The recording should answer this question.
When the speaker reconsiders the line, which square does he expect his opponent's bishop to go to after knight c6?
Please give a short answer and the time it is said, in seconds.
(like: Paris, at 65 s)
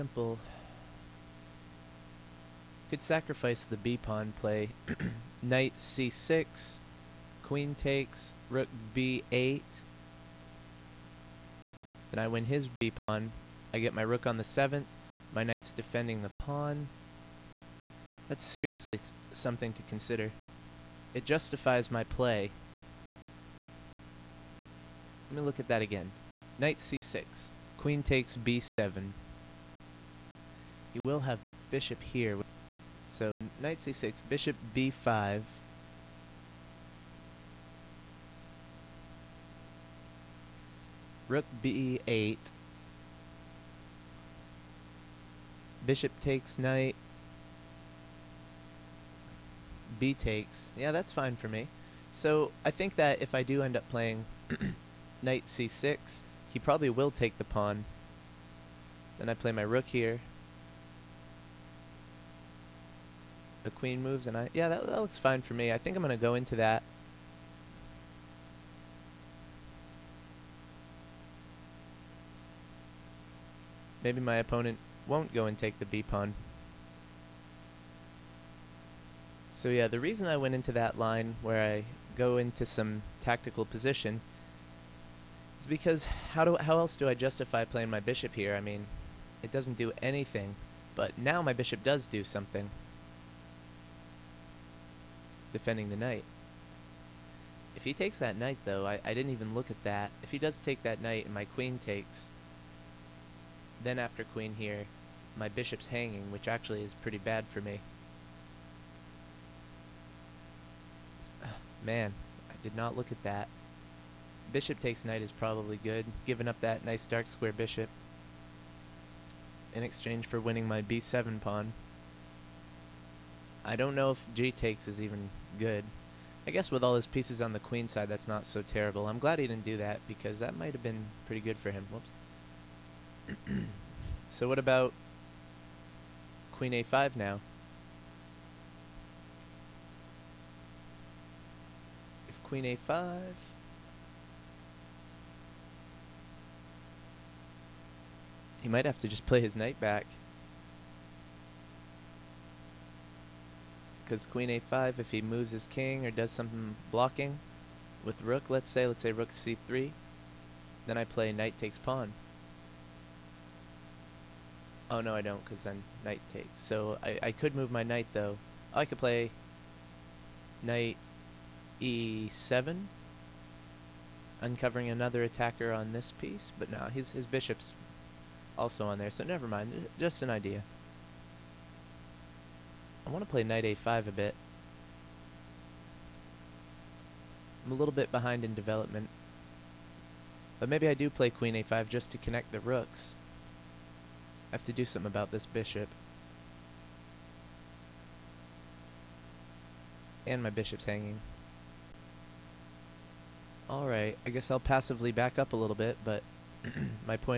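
b5, at 34 s.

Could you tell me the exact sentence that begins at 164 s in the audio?
Oh no, I don't, because then knight takes.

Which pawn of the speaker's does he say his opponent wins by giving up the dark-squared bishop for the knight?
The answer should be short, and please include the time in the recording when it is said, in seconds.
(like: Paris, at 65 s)
b7 pawn, at 120 s.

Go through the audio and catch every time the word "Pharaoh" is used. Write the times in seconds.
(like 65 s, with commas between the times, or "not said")
not said.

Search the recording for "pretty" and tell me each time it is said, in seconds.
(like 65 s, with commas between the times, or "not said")
106 s, 131 s.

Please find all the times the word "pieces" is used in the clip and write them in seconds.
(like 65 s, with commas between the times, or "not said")
127 s, 176 s.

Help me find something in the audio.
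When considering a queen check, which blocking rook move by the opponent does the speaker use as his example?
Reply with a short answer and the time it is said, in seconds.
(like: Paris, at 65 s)
rook c3, at 159 s.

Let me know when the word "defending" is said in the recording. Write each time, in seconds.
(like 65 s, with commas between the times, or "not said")
15 s, 95 s.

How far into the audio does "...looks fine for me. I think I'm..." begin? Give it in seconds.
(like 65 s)
65 s.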